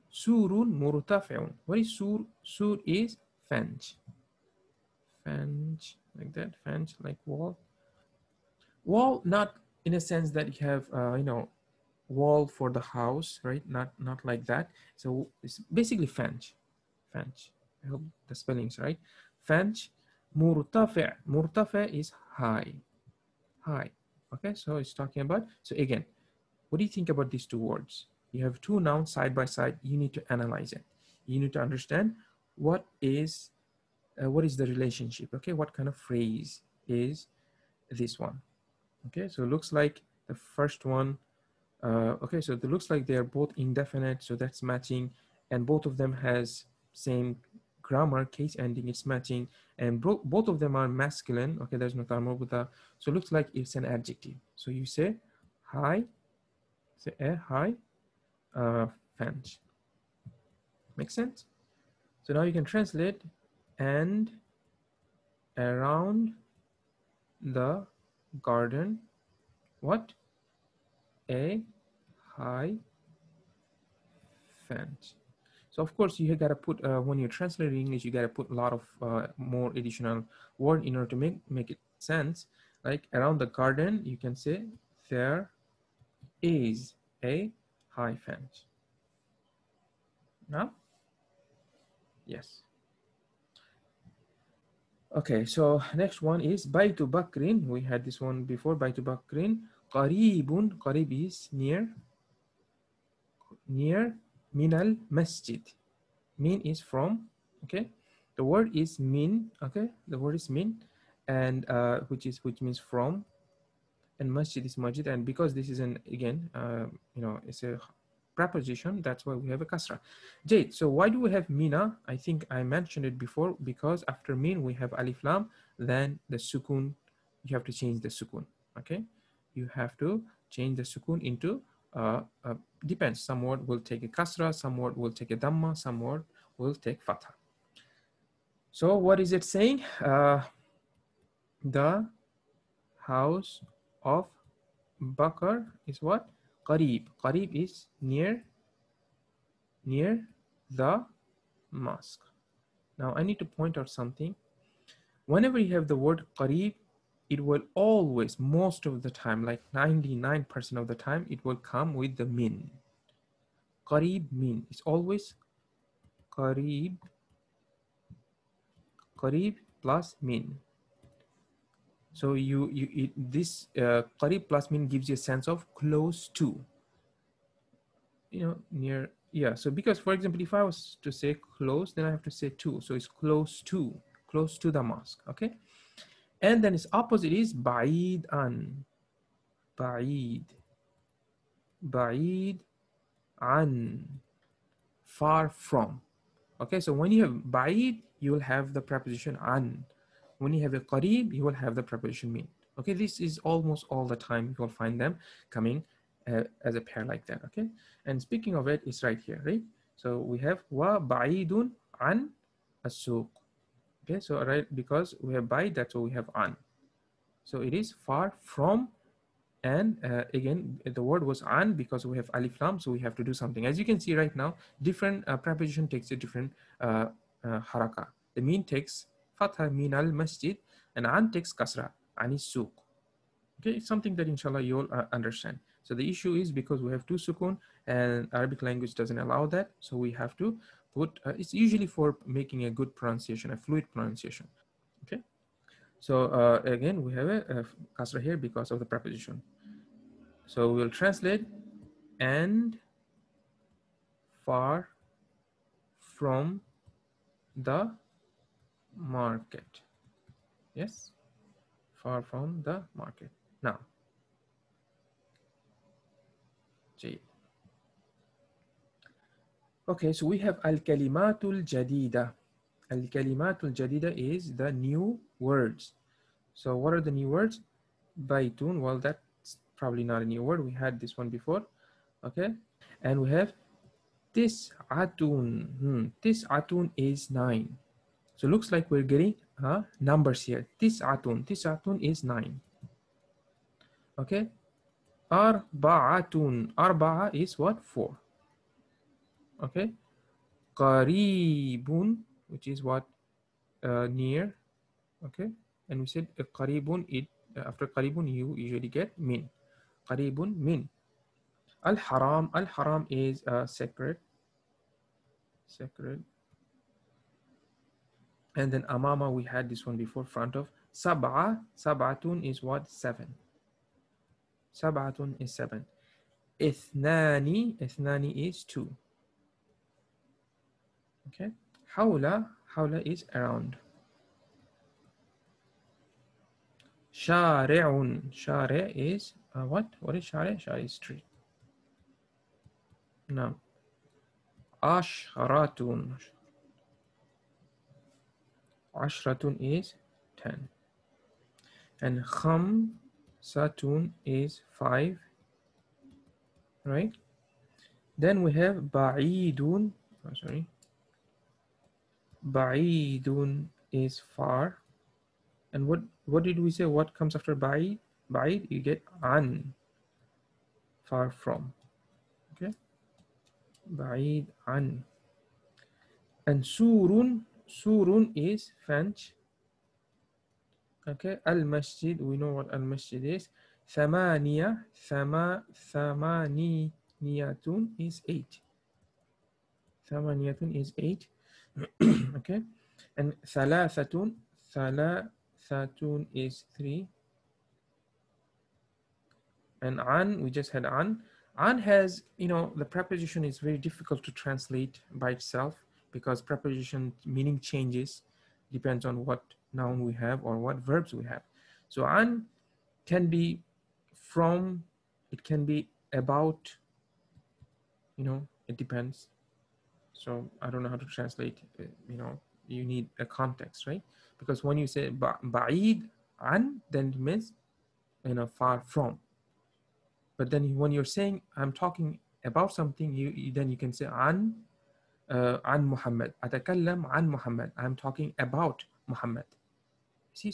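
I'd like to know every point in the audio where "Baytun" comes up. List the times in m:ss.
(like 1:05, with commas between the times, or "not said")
4:38.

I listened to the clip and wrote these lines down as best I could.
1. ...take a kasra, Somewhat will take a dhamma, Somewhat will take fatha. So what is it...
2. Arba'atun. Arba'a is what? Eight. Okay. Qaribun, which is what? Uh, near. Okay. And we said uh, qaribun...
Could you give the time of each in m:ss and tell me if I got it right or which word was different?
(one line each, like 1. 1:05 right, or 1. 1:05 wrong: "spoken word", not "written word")
1. 2:13 right
2. 4:55 wrong: "Four", not "Eight".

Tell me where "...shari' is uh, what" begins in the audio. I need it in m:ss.
5:38.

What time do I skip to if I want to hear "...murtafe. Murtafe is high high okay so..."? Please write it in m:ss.
0:20.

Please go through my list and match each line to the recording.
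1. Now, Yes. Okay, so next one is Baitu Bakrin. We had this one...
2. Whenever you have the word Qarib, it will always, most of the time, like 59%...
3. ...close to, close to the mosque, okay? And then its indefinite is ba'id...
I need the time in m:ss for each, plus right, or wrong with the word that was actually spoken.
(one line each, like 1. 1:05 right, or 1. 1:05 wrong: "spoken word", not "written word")
1. 1:30 right
2. 2:35 wrong: "99", not "59"
3. 3:03 wrong: "opposite", not "indefinite".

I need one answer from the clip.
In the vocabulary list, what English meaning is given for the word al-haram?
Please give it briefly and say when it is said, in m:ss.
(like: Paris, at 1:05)
sacred, at 5:12.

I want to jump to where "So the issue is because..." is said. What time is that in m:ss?
3:55.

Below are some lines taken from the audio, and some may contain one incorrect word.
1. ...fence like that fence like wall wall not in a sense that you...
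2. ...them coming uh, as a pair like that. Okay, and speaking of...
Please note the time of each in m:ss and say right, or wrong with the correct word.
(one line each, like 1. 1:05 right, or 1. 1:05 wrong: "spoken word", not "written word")
1. 0:05 right
2. 3:24 right.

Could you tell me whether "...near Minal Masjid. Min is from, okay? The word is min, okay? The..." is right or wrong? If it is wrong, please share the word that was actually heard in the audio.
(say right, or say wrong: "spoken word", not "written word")
right.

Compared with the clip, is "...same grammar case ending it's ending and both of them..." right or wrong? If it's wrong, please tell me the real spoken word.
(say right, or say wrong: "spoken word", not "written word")
wrong: "matching", not "ending".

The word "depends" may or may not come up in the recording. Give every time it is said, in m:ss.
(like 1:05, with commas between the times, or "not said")
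2:12, 6:48, 6:58.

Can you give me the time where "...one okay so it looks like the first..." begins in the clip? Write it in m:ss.
0:38.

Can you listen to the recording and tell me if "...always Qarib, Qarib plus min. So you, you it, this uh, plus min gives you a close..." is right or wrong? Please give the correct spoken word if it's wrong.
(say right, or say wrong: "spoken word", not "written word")
wrong: "sense", not "close".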